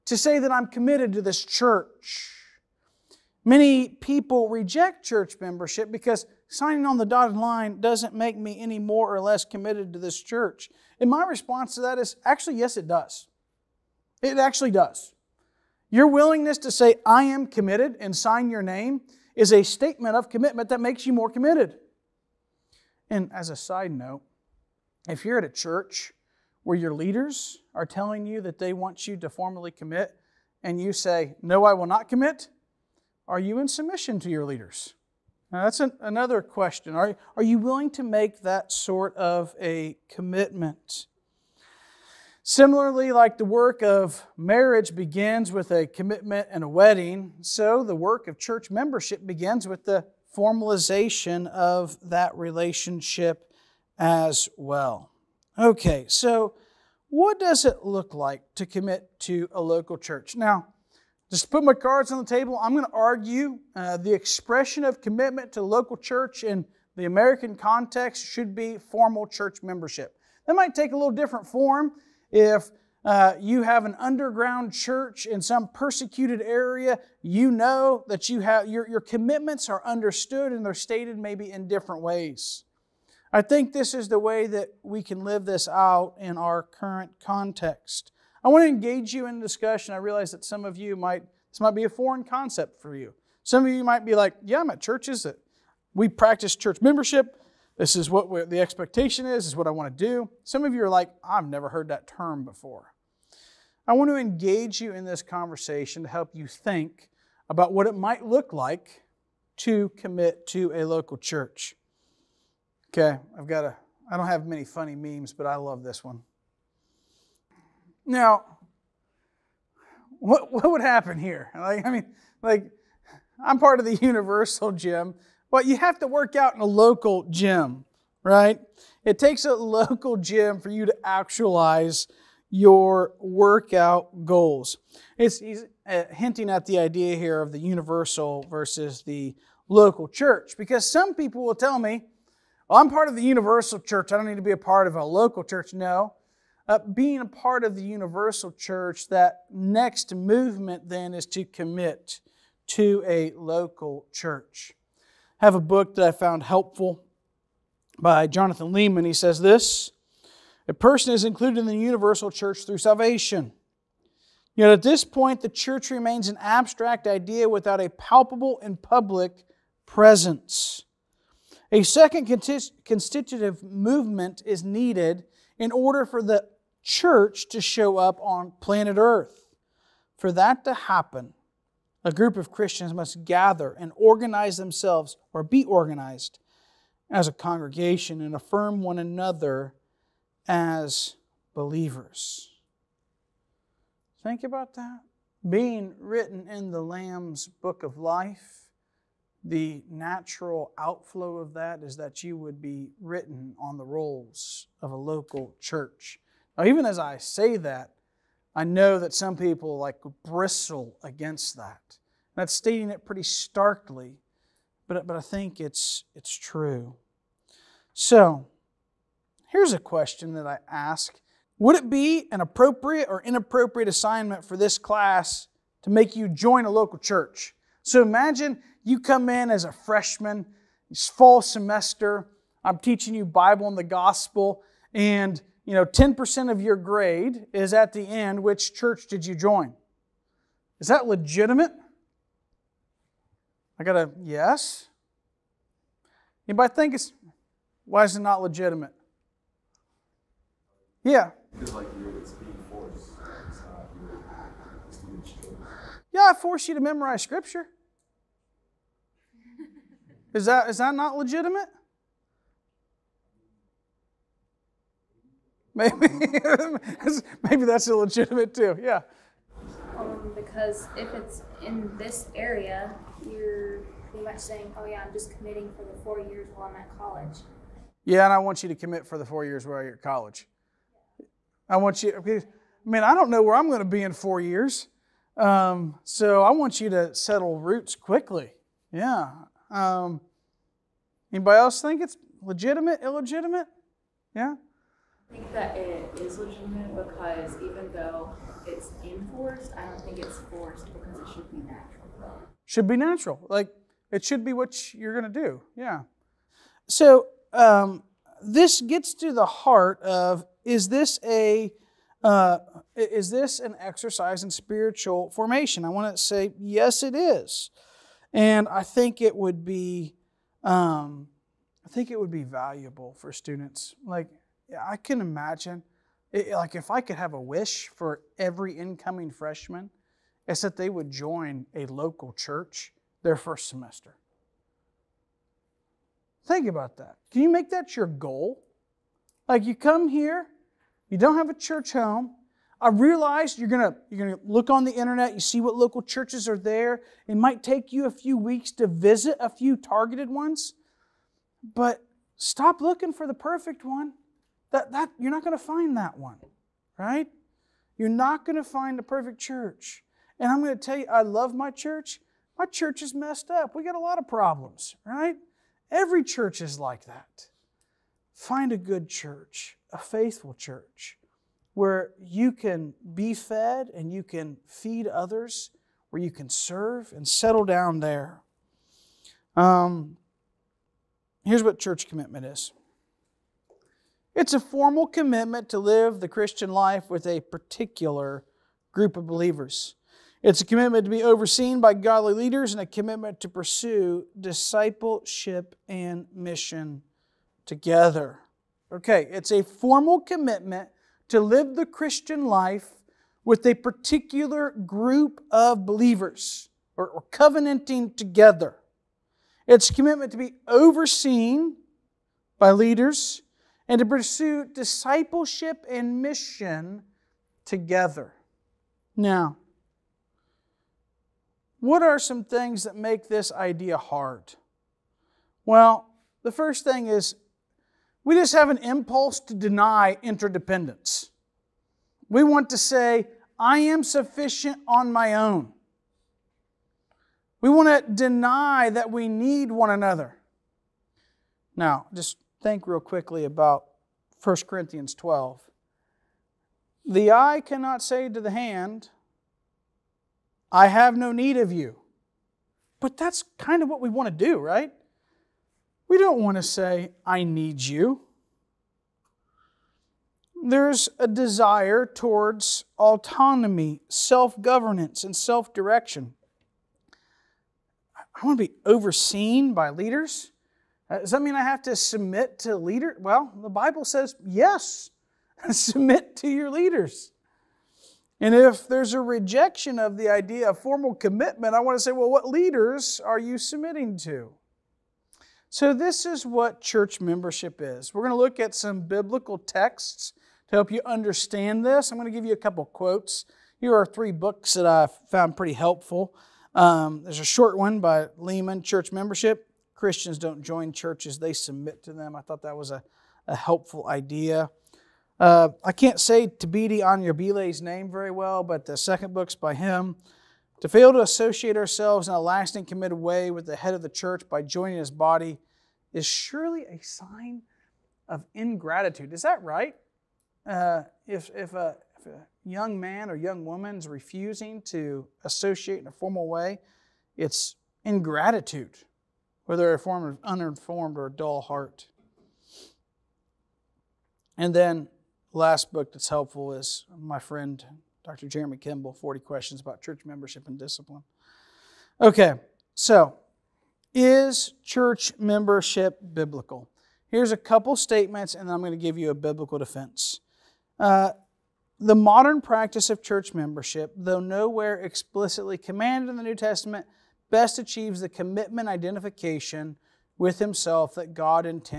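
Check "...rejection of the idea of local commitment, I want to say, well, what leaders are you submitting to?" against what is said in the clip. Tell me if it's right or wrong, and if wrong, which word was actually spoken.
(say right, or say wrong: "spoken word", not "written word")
wrong: "formal", not "local".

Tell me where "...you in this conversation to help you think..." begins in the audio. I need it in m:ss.
1:44.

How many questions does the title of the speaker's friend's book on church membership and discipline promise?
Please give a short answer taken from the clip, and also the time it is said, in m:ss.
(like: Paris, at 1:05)
40, at 8:59.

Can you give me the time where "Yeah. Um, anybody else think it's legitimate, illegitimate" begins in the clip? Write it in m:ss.
4:48.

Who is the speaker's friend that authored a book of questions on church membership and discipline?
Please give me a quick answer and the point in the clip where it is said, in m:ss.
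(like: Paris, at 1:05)
Jeremy Kimble, at 8:58.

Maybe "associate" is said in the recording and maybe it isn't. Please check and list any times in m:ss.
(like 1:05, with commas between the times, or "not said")
8:31, 8:45.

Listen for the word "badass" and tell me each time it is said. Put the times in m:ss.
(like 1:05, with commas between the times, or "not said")
not said.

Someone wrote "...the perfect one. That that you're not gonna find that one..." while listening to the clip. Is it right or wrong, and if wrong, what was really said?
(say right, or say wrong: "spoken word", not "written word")
right.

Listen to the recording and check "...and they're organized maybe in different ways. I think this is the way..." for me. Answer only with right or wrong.
wrong.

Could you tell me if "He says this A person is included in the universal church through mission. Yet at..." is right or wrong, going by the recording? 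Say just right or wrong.
wrong.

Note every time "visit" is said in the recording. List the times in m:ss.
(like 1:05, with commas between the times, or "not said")
5:48.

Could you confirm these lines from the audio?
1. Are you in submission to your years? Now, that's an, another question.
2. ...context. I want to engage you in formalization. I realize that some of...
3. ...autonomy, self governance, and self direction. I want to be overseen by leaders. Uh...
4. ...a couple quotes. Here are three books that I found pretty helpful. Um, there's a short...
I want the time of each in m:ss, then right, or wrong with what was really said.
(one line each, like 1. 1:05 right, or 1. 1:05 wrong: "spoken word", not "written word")
1. 0:33 wrong: "leaders", not "years"
2. 1:27 wrong: "discussion", not "formalization"
3. 7:42 right
4. 8:12 right.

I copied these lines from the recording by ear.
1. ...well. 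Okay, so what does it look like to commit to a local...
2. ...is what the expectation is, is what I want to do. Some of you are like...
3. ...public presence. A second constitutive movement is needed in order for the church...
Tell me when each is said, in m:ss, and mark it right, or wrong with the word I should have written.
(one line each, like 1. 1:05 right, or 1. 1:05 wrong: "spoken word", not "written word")
1. 0:54 right
2. 1:37 right
3. 2:48 right.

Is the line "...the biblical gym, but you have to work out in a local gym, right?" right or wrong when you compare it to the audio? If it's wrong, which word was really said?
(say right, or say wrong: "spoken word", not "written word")
wrong: "universal", not "biblical".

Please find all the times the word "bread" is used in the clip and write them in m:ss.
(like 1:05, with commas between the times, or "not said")
not said.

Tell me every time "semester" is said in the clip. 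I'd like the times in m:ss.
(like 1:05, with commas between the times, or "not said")
3:51, 5:33.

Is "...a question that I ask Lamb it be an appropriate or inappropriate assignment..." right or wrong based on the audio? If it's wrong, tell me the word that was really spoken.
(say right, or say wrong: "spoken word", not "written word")
wrong: "Would", not "Lamb".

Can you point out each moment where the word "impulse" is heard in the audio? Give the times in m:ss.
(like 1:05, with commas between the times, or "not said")
7:08.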